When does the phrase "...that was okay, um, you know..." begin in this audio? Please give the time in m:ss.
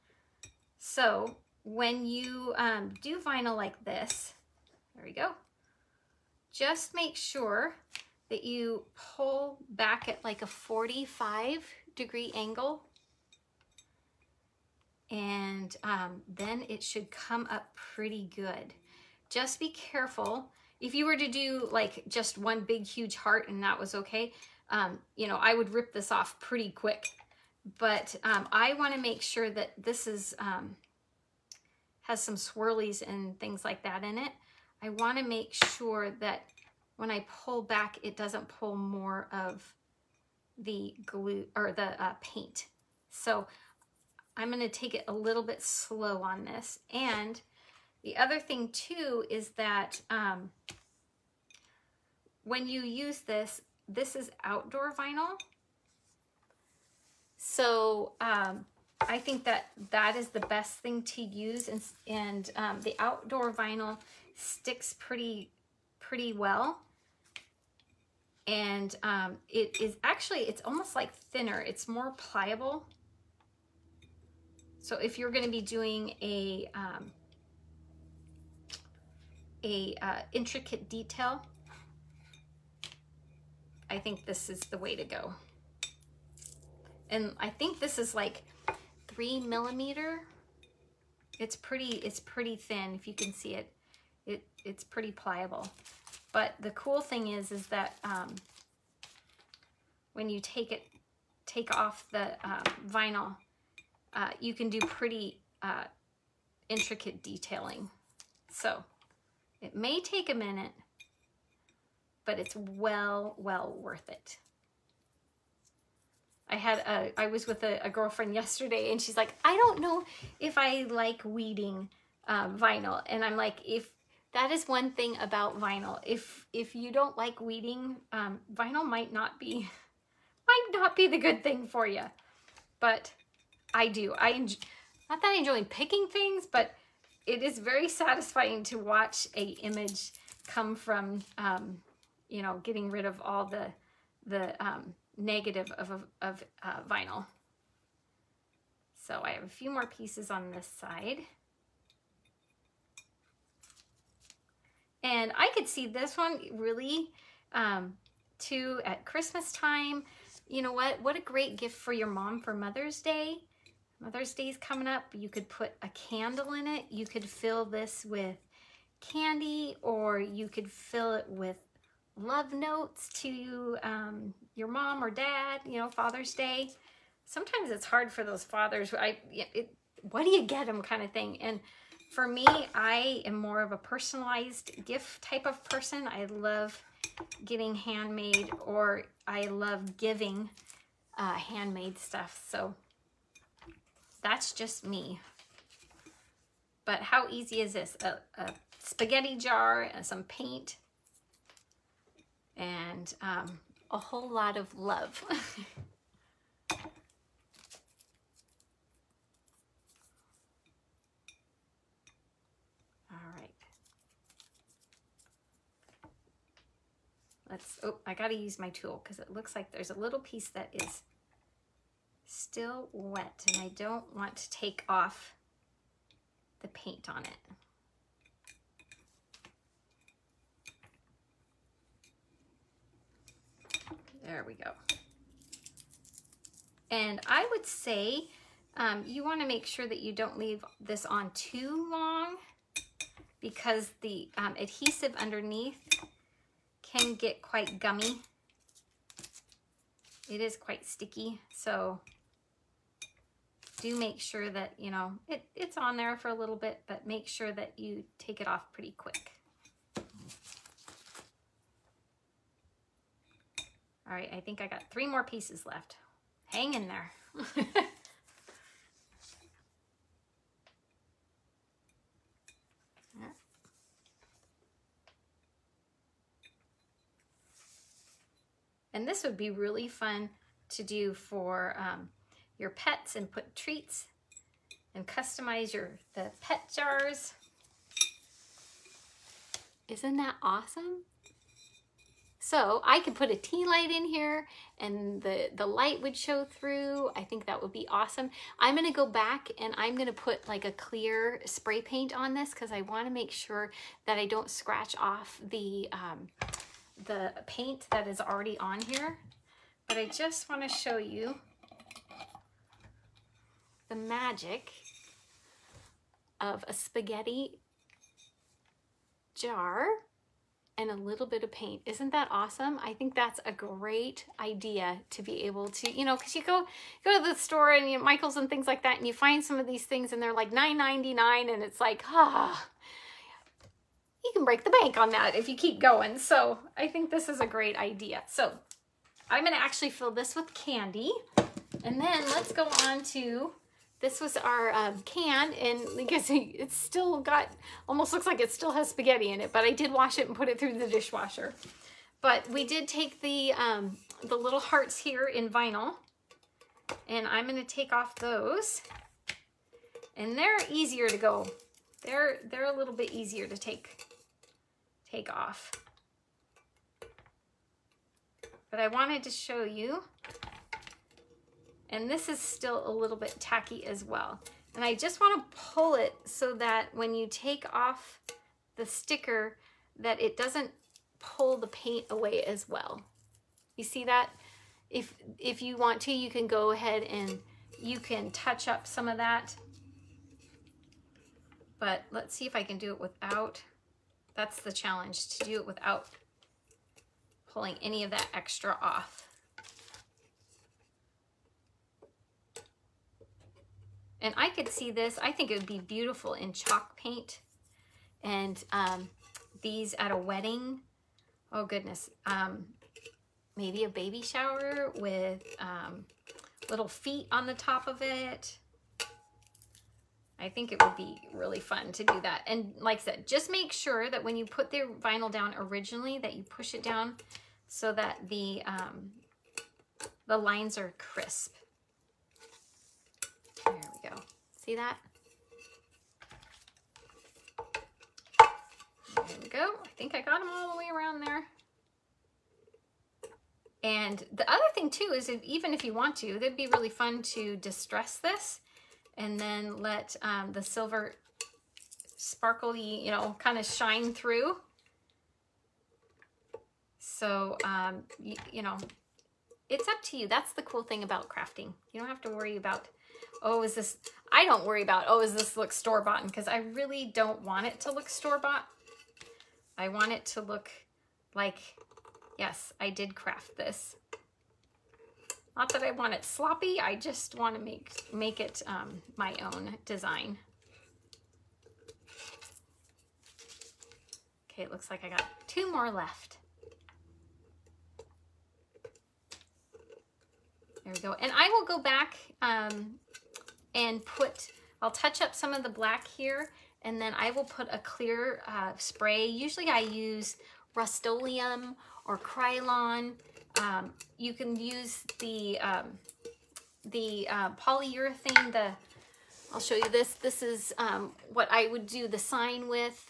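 0:23.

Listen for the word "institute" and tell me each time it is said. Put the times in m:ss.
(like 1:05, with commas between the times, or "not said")
not said.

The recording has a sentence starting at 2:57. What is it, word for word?
Sometimes it's hard for those fathers.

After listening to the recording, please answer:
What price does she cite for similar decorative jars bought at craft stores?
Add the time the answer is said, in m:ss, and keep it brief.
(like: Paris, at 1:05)
$9.99, at 5:30.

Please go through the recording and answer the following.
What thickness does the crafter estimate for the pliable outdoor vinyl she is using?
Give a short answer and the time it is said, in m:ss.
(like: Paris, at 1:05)
3 millimeter, at 1:29.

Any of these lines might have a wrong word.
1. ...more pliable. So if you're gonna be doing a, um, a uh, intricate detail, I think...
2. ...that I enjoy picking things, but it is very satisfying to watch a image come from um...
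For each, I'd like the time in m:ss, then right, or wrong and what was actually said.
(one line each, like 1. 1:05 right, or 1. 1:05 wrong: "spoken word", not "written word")
1. 1:11 right
2. 2:15 right.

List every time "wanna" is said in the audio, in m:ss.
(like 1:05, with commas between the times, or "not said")
0:28, 0:34, 3:59, 5:02, 6:15.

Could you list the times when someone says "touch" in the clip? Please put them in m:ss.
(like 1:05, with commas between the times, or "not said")
6:28, 8:14.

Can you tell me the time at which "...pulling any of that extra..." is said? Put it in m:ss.
6:37.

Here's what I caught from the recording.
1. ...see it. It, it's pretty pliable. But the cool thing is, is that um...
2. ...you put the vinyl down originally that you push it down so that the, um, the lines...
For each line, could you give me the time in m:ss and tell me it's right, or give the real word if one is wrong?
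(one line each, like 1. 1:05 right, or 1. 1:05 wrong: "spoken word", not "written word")
1. 1:33 right
2. 7:04 right.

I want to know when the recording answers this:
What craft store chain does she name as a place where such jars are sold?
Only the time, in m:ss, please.
5:28.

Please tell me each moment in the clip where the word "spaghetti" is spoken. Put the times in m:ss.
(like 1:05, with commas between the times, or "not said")
3:18, 5:16, 5:48.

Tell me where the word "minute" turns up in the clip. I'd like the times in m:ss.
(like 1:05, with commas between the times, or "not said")
1:50.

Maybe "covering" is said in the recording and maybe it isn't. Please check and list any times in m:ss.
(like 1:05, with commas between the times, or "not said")
not said.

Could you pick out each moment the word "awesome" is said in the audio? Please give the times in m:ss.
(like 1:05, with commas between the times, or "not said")
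4:50, 4:57, 5:22.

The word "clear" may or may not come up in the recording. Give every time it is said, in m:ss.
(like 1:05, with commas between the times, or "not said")
5:00, 8:17.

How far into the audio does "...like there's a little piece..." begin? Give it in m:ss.
3:39.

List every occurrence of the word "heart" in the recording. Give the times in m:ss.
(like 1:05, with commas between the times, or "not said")
0:23, 5:54.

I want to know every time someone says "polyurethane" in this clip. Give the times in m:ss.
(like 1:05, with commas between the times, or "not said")
8:27.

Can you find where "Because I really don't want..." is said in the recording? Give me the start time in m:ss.
7:46.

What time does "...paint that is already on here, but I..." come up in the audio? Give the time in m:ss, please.
5:07.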